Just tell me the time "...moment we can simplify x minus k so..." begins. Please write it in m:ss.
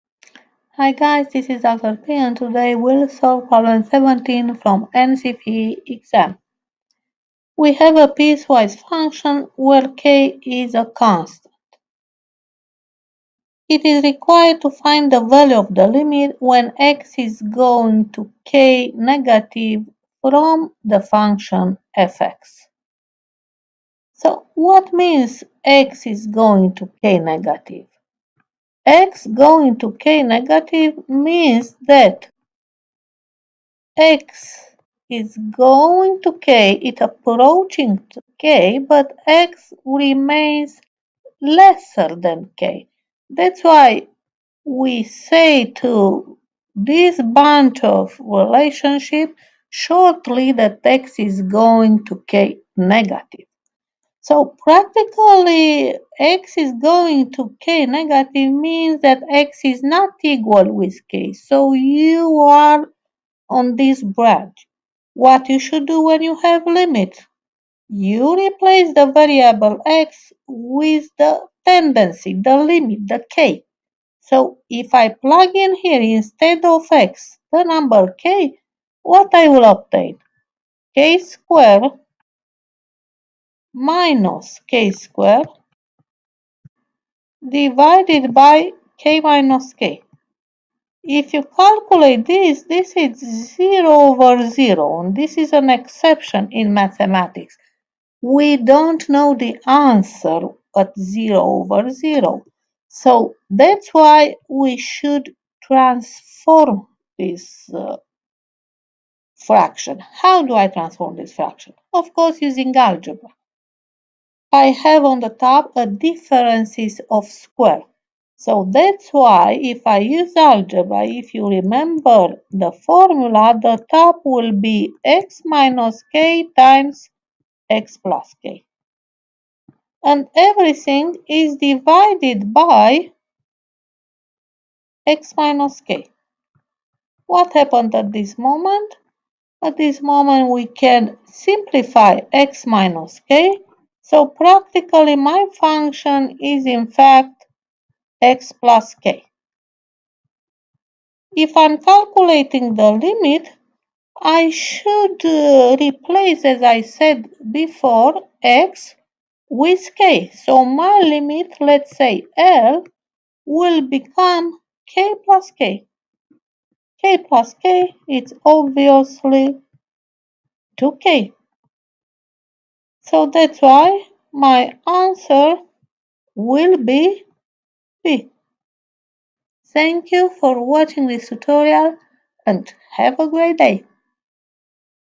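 2:20.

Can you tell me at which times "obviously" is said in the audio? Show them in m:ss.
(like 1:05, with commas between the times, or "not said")
2:48.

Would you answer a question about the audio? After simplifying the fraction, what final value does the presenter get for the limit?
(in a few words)
2k.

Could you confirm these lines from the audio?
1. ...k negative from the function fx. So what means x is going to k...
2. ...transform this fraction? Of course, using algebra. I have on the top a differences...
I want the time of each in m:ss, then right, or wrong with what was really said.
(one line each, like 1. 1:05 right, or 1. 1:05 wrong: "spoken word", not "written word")
1. 0:18 right
2. 1:50 right.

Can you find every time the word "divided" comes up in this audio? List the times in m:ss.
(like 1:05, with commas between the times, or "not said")
1:27, 2:11.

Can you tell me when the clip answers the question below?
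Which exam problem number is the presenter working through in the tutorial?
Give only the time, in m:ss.
0:03.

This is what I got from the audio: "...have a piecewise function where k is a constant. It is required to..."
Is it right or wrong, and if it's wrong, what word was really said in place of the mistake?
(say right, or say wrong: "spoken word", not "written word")
right.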